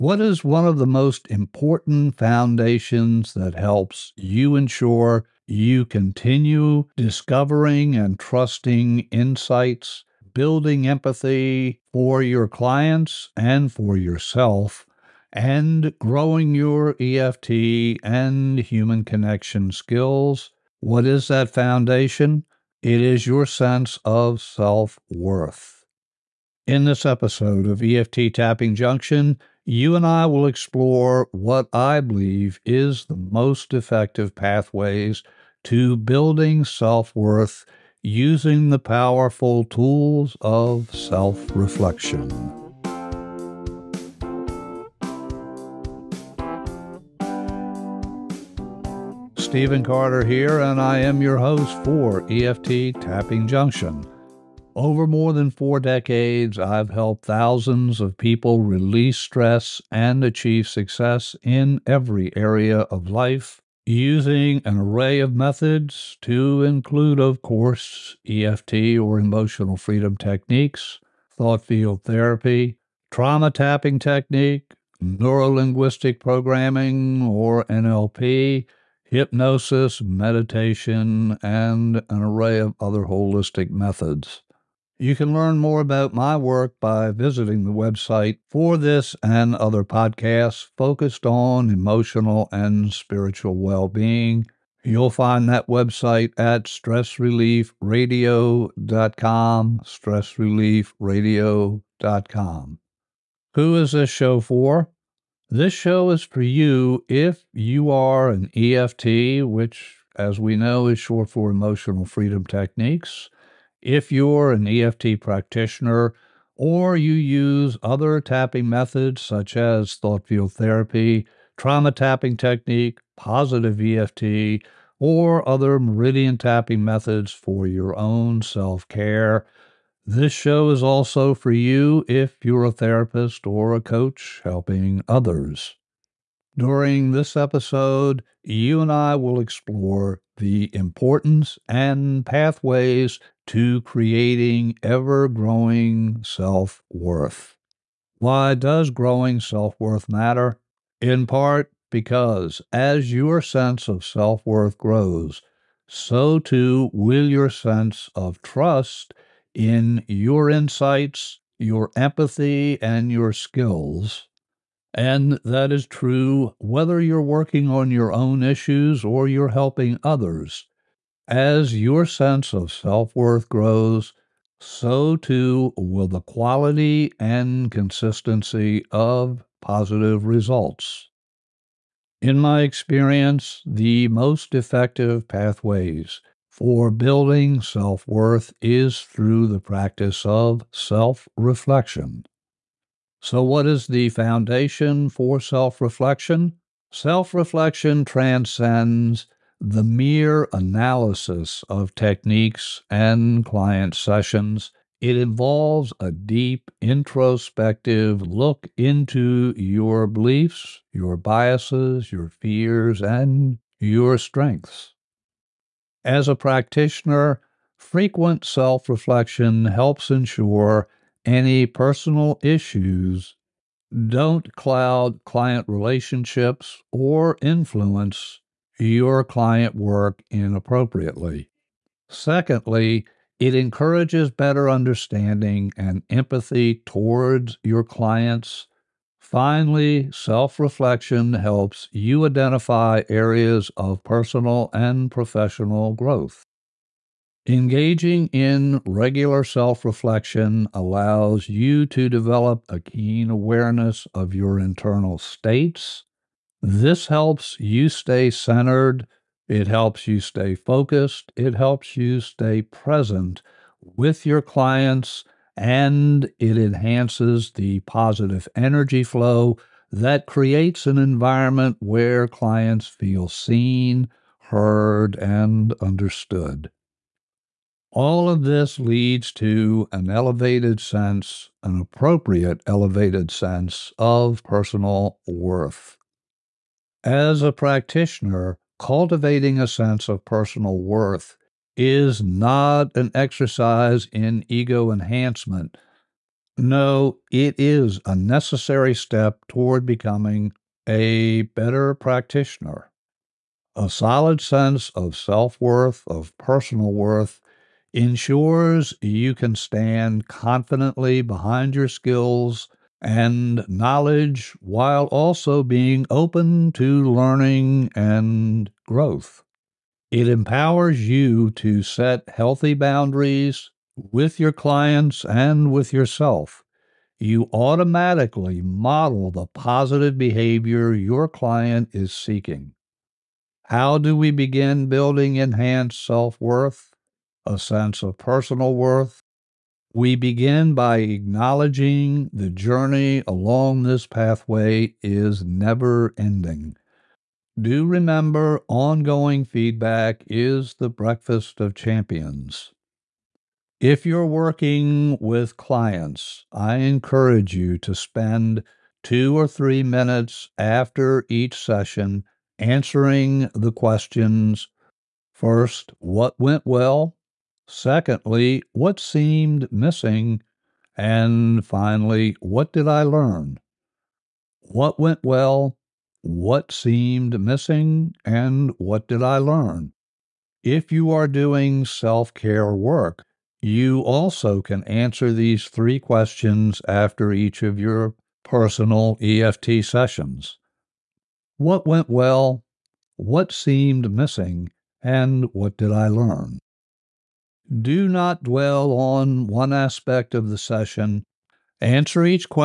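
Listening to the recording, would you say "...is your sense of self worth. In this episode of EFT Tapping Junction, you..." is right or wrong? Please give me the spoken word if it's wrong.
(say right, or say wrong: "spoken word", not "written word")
right.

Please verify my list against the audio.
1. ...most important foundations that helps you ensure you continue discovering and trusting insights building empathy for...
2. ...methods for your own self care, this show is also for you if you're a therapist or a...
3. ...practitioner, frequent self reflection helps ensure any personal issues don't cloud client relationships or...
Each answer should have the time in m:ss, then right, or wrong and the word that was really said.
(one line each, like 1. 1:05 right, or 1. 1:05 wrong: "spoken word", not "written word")
1. 0:00 right
2. 2:06 right
3. 3:36 right.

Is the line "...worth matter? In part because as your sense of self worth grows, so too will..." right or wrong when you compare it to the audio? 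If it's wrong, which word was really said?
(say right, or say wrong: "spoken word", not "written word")
right.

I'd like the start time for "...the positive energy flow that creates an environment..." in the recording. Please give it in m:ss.
4:27.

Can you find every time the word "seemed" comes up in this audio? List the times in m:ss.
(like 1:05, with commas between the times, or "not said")
6:08, 6:16, 6:33.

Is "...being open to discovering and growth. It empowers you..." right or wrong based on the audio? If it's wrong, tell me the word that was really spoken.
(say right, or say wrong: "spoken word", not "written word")
wrong: "learning", not "discovering".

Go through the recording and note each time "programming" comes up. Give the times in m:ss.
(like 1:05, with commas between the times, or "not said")
1:16.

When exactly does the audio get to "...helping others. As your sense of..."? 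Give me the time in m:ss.
2:49.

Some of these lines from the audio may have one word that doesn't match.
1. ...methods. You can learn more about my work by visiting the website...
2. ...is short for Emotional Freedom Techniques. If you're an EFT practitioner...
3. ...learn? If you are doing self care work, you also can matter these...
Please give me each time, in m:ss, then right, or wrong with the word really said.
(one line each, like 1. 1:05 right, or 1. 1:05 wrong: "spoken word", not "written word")
1. 1:23 right
2. 1:50 right
3. 6:19 wrong: "answer", not "matter".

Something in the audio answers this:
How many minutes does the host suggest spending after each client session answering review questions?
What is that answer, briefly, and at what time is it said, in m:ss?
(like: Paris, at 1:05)
2 or 3, at 5:59.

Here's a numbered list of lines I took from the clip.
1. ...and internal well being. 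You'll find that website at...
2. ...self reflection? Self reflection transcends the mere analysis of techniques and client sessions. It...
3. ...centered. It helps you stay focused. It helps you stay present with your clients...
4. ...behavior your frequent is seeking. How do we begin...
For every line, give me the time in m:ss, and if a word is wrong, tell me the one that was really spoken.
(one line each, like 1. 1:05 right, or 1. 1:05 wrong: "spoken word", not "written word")
1. 1:32 wrong: "spiritual", not "internal"
2. 3:15 right
3. 4:18 right
4. 5:30 wrong: "client", not "frequent".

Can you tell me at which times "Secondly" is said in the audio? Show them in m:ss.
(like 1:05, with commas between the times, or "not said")
3:52, 6:07.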